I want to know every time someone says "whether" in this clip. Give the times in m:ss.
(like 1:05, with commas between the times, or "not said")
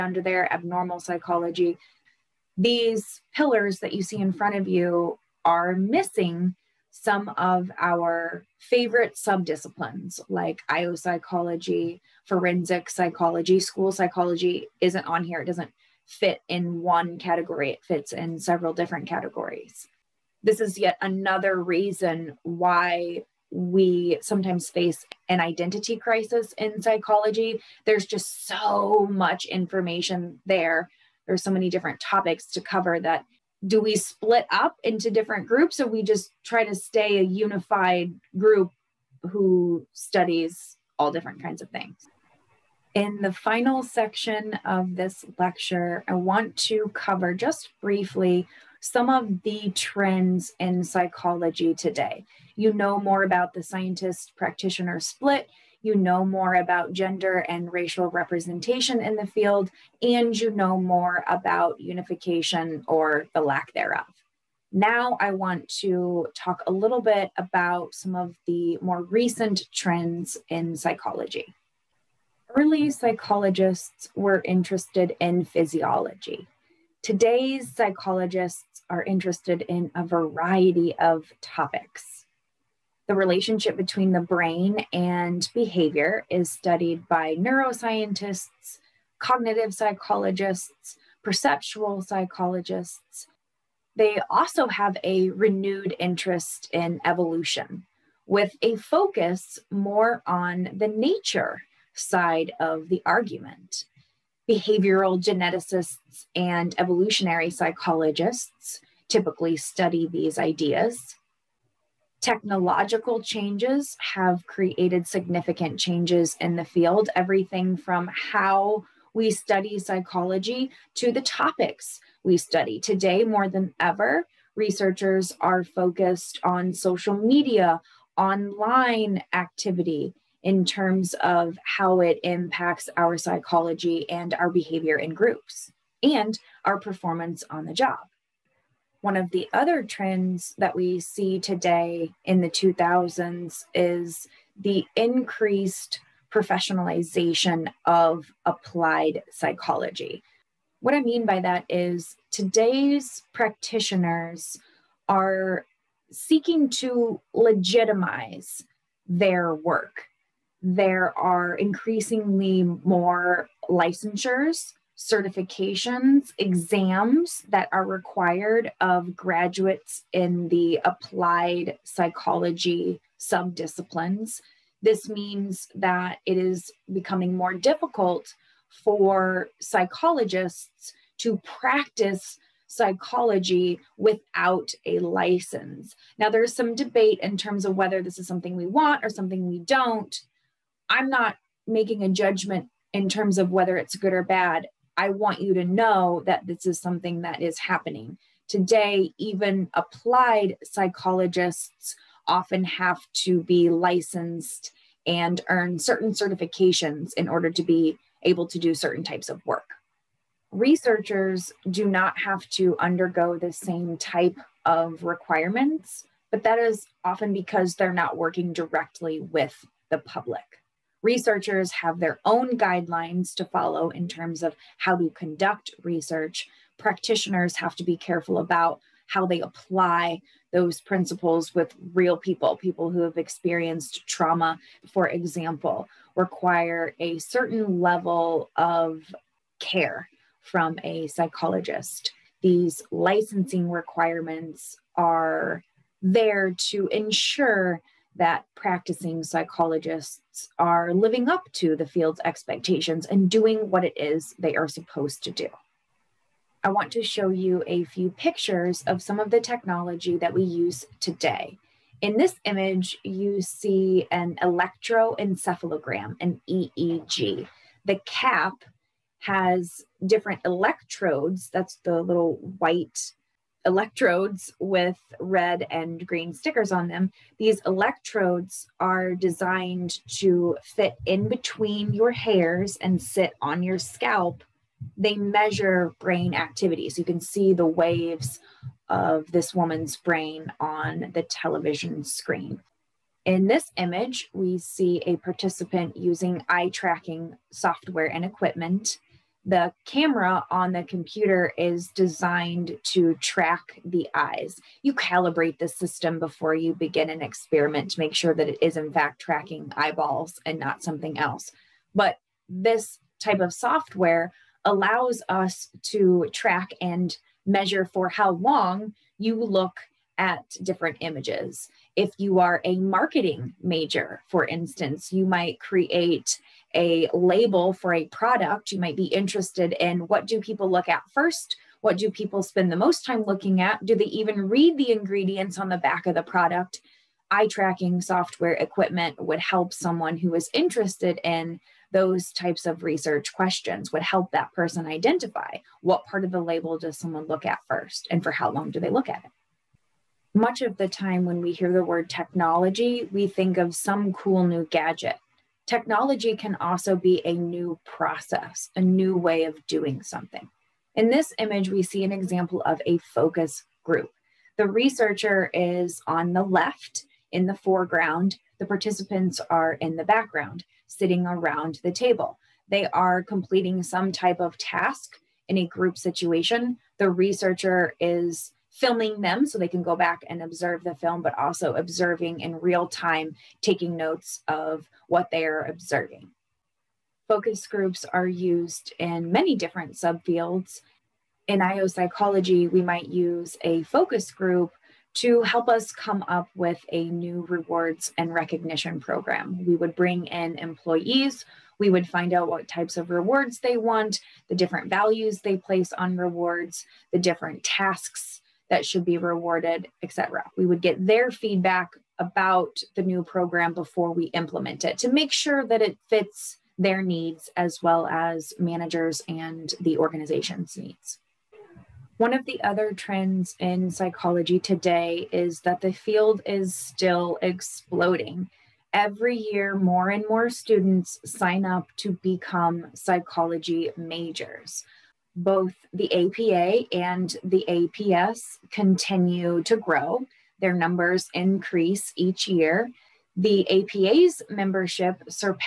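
3:07, 3:13.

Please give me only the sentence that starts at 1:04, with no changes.
Now, I want to talk a little bit about some of the more recent trends in psychology.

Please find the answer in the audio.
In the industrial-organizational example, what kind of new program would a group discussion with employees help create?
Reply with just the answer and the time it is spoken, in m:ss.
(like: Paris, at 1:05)
Rewards and recognition program, at 6:37.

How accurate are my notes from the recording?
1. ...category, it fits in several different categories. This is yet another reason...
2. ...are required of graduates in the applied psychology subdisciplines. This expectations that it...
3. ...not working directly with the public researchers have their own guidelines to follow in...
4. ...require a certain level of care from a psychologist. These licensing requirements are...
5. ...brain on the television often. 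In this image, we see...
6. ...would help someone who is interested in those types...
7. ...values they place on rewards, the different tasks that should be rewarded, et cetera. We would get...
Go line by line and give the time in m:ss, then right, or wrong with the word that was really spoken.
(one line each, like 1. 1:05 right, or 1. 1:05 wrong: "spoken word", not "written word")
1. 0:17 right
2. 2:47 wrong: "means", not "expectations"
3. 3:37 right
4. 3:56 right
5. 4:49 wrong: "screen", not "often"
6. 5:39 right
7. 6:44 right.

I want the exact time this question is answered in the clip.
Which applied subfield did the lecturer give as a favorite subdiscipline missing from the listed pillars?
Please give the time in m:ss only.
0:12.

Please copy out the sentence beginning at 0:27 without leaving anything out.
There's just so much information there.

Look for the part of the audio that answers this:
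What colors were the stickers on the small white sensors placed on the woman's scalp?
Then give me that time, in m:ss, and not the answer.
4:35.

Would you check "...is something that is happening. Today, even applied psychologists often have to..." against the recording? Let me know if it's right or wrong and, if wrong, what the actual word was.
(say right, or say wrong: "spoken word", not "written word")
right.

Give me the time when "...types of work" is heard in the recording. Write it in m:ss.
3:29.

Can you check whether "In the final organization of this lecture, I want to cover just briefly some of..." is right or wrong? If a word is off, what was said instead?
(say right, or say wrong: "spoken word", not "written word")
wrong: "section", not "organization".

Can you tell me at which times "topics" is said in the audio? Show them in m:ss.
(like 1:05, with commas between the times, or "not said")
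0:31, 1:21, 2:01.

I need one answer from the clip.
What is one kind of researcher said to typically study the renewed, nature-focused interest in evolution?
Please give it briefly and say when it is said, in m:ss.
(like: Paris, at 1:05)
Behavioral geneticists, at 1:44.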